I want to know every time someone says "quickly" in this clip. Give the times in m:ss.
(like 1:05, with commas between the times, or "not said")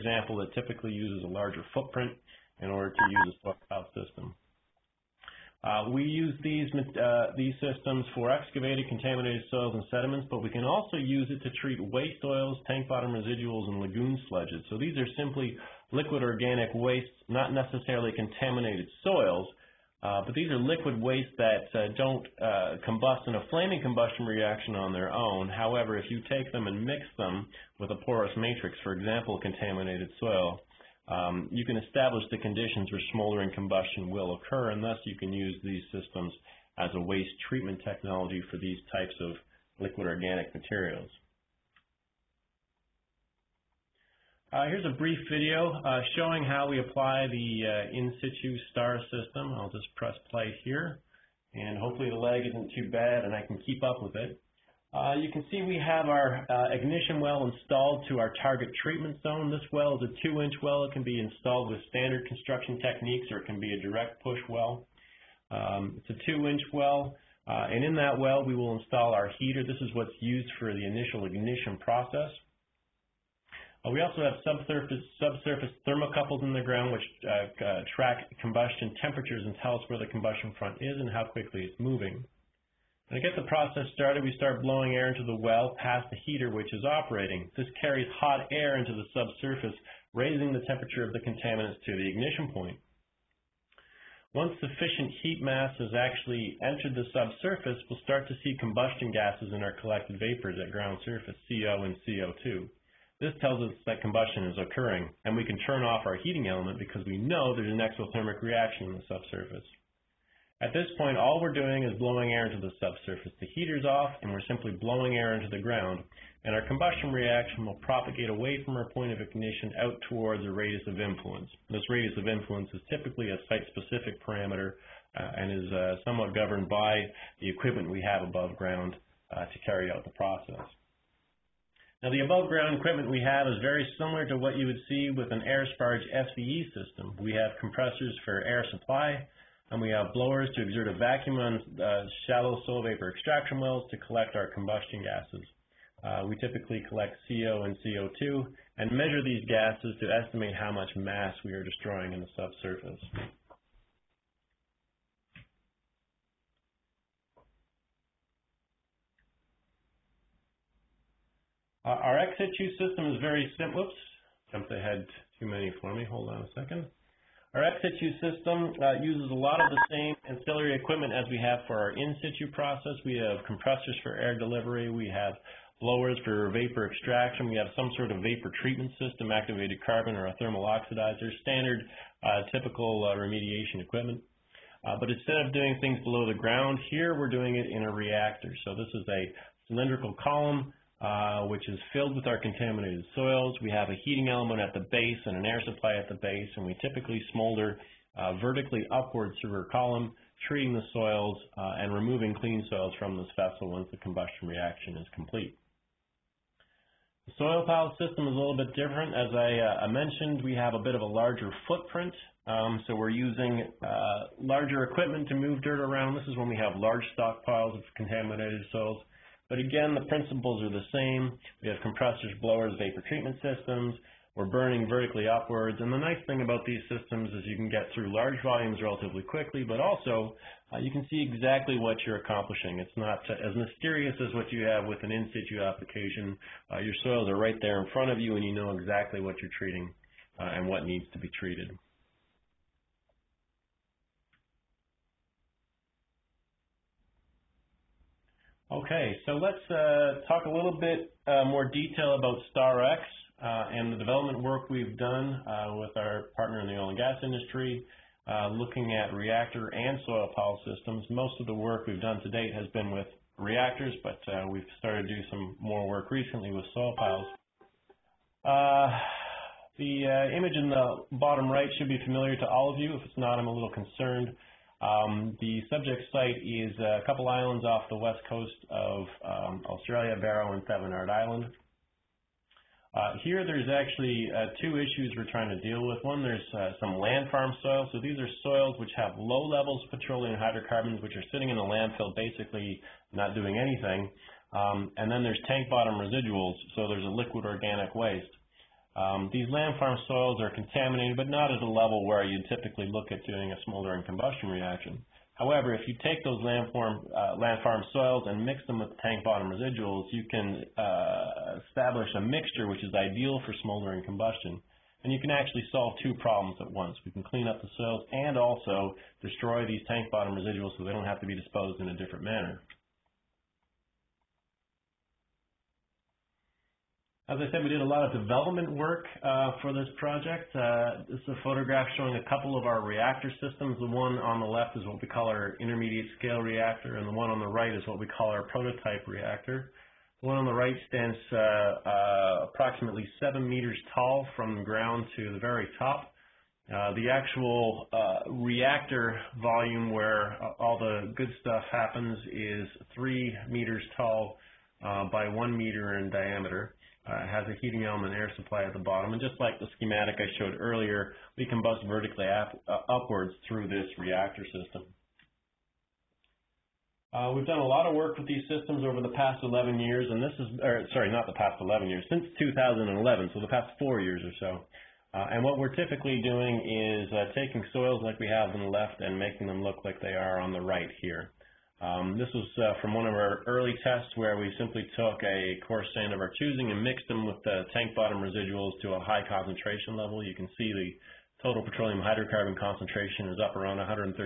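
1:21, 3:49.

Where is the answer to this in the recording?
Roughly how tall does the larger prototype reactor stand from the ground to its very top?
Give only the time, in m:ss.
5:43.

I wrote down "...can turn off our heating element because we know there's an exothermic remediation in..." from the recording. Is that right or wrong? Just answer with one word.
wrong.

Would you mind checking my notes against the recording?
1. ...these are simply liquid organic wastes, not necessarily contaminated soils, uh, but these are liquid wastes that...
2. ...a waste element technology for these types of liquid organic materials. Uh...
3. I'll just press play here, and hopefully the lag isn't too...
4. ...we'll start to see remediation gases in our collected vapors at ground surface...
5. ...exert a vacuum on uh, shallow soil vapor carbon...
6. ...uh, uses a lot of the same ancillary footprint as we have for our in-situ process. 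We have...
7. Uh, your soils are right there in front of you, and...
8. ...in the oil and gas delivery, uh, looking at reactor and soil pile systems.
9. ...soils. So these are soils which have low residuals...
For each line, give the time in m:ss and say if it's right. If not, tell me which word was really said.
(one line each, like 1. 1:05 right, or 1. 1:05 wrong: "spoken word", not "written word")
1. 0:14 right
2. 0:36 wrong: "treatment", not "element"
3. 0:49 right
4. 1:37 wrong: "combustion", not "remediation"
5. 2:20 wrong: "extraction", not "carbon"
6. 2:48 wrong: "equipment", not "footprint"
7. 3:56 right
8. 4:16 wrong: "industry", not "delivery"
9. 4:47 wrong: "levels", not "residuals".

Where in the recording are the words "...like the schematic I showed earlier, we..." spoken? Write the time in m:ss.
5:59.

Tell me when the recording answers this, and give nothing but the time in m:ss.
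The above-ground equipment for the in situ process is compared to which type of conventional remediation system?
2:15.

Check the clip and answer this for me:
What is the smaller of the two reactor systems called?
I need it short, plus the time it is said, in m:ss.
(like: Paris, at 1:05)
Intermediate scale reactor, at 5:35.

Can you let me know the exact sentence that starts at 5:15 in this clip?
And you can actually solve two problems at once.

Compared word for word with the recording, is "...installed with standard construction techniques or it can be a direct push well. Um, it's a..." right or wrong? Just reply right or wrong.
right.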